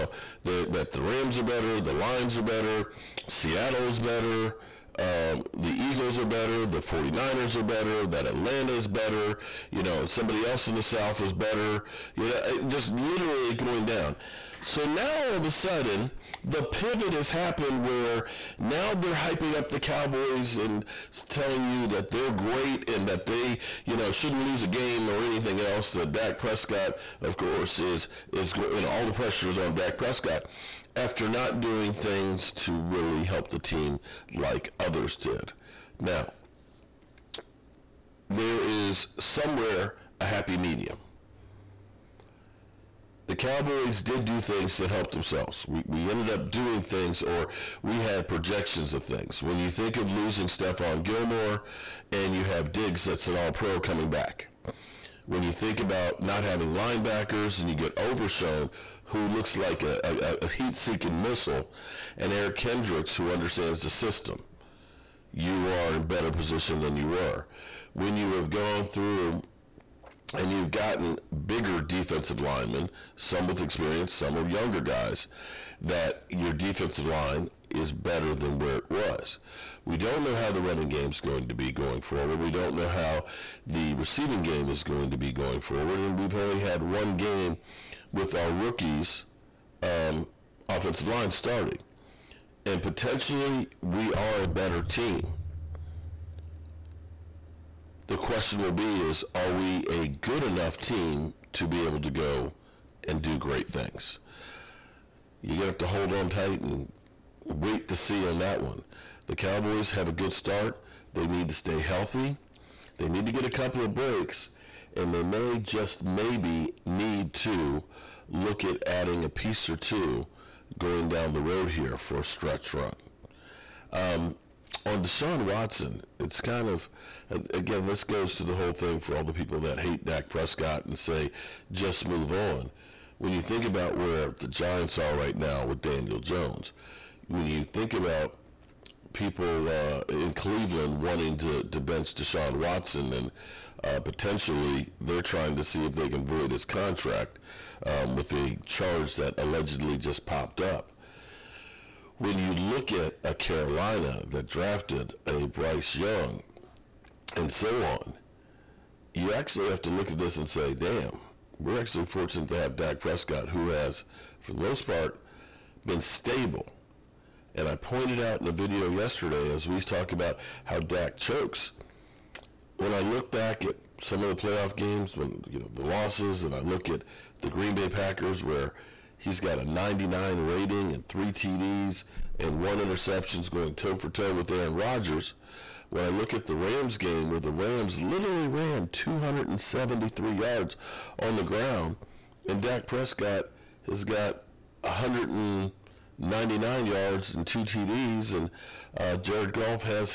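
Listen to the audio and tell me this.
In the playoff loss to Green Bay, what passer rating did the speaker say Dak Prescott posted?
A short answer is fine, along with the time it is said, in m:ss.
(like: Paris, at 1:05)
99, at 2:59.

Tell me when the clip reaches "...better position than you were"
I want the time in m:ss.
1:06.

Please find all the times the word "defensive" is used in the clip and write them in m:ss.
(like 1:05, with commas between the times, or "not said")
1:11, 1:16.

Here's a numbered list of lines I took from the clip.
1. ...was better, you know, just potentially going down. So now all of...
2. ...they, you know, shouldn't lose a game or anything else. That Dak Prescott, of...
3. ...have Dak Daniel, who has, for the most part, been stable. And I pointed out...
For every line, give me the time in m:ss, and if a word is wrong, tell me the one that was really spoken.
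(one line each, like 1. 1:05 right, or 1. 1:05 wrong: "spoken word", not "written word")
1. 0:11 wrong: "literally", not "potentially"
2. 0:23 right
3. 2:42 wrong: "Prescott", not "Daniel".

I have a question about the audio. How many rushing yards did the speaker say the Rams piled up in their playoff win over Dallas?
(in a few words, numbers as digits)
273.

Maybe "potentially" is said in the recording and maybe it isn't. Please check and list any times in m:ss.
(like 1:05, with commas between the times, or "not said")
1:32, 2:23.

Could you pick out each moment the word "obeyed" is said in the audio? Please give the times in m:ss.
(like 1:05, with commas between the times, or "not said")
not said.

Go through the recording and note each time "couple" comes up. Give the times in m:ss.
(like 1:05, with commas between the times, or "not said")
1:53.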